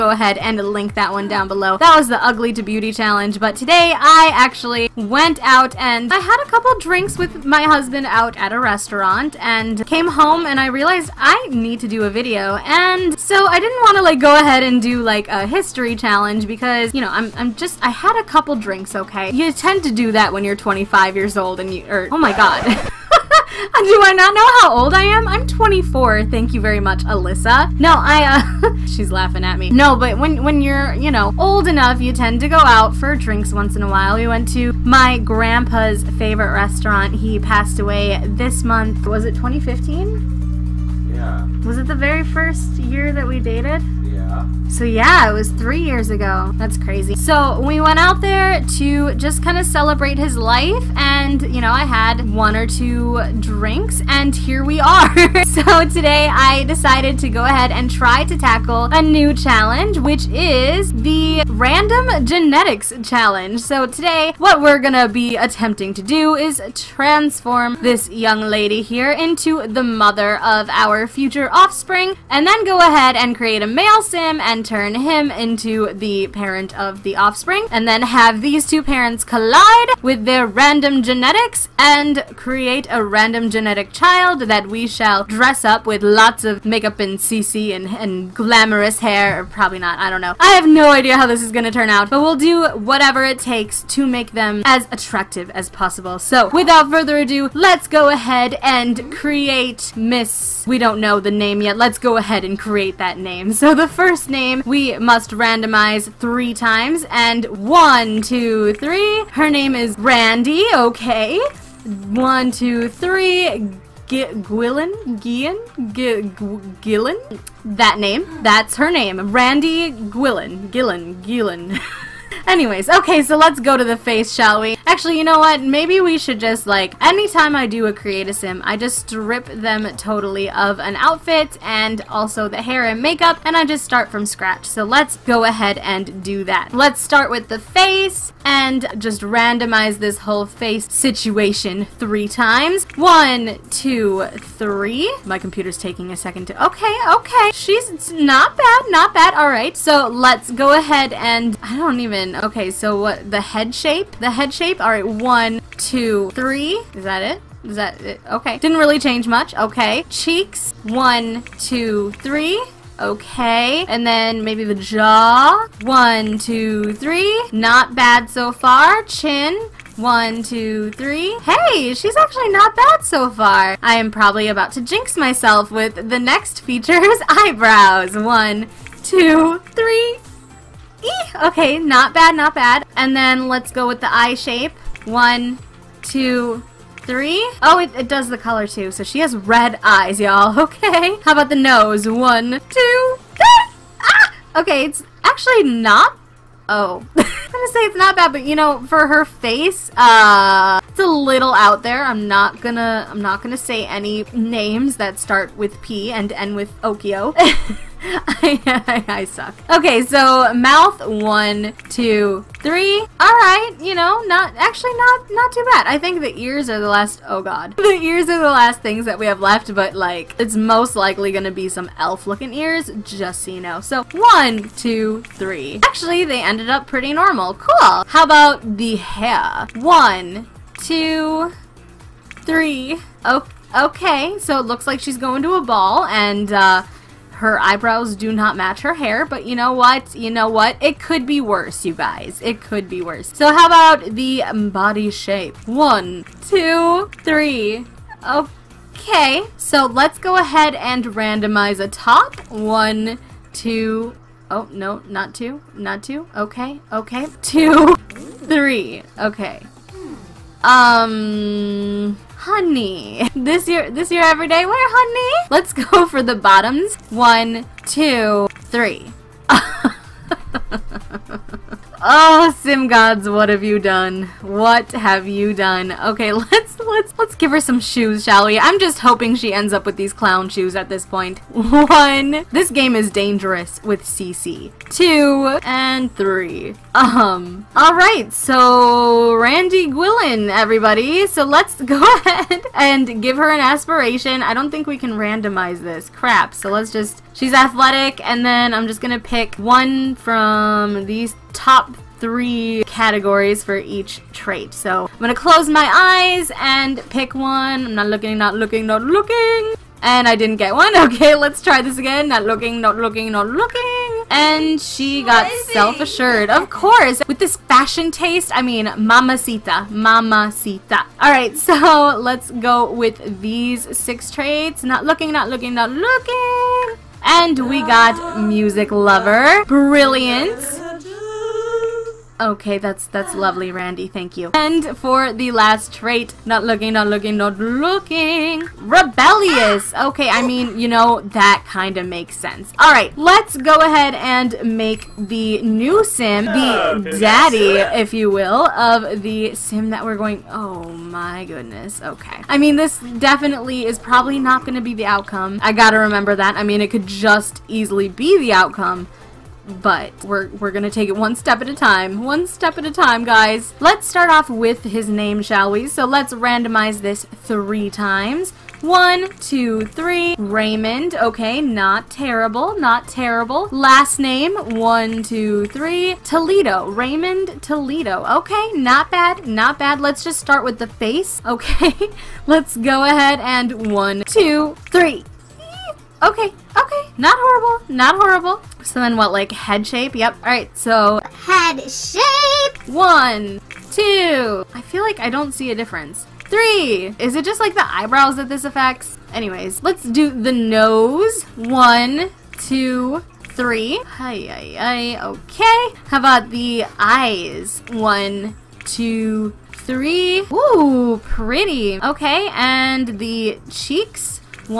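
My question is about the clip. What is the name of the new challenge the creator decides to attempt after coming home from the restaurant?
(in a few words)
Random Genetics Challenge.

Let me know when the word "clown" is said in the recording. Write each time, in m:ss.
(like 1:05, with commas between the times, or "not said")
4:40.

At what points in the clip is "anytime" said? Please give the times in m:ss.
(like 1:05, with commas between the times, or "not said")
2:07.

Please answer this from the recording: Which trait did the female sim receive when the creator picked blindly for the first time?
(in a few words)
Self-assured.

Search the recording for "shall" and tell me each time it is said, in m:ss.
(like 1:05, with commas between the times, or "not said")
1:24, 2:04, 4:38, 6:05.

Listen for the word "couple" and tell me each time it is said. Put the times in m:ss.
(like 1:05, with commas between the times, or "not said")
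0:06, 0:18.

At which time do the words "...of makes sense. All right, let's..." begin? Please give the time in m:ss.
5:41.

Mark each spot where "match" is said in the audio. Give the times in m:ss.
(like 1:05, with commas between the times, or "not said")
3:58.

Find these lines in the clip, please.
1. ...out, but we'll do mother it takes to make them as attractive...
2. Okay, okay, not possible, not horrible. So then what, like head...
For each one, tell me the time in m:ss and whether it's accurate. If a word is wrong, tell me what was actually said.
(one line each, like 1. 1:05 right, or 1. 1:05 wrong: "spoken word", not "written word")
1. 1:31 wrong: "whatever", not "mother"
2. 6:26 wrong: "horrible", not "possible".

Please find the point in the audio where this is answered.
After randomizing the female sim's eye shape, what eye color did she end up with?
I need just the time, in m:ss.
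3:09.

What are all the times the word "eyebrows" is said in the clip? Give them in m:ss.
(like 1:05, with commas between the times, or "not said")
2:57, 3:57, 6:37.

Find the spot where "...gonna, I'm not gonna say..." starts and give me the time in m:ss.
3:22.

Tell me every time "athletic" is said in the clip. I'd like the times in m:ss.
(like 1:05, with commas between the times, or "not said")
4:57.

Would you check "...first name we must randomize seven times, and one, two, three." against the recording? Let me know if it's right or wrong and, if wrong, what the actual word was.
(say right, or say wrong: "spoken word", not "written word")
wrong: "three", not "seven".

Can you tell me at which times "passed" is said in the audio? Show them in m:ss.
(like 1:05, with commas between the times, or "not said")
0:37.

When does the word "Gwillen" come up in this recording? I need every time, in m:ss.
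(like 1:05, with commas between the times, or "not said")
1:54, 1:59, 4:49.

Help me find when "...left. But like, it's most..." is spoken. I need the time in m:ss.
3:39.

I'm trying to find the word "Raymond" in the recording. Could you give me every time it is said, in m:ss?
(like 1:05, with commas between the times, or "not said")
6:10, 6:16.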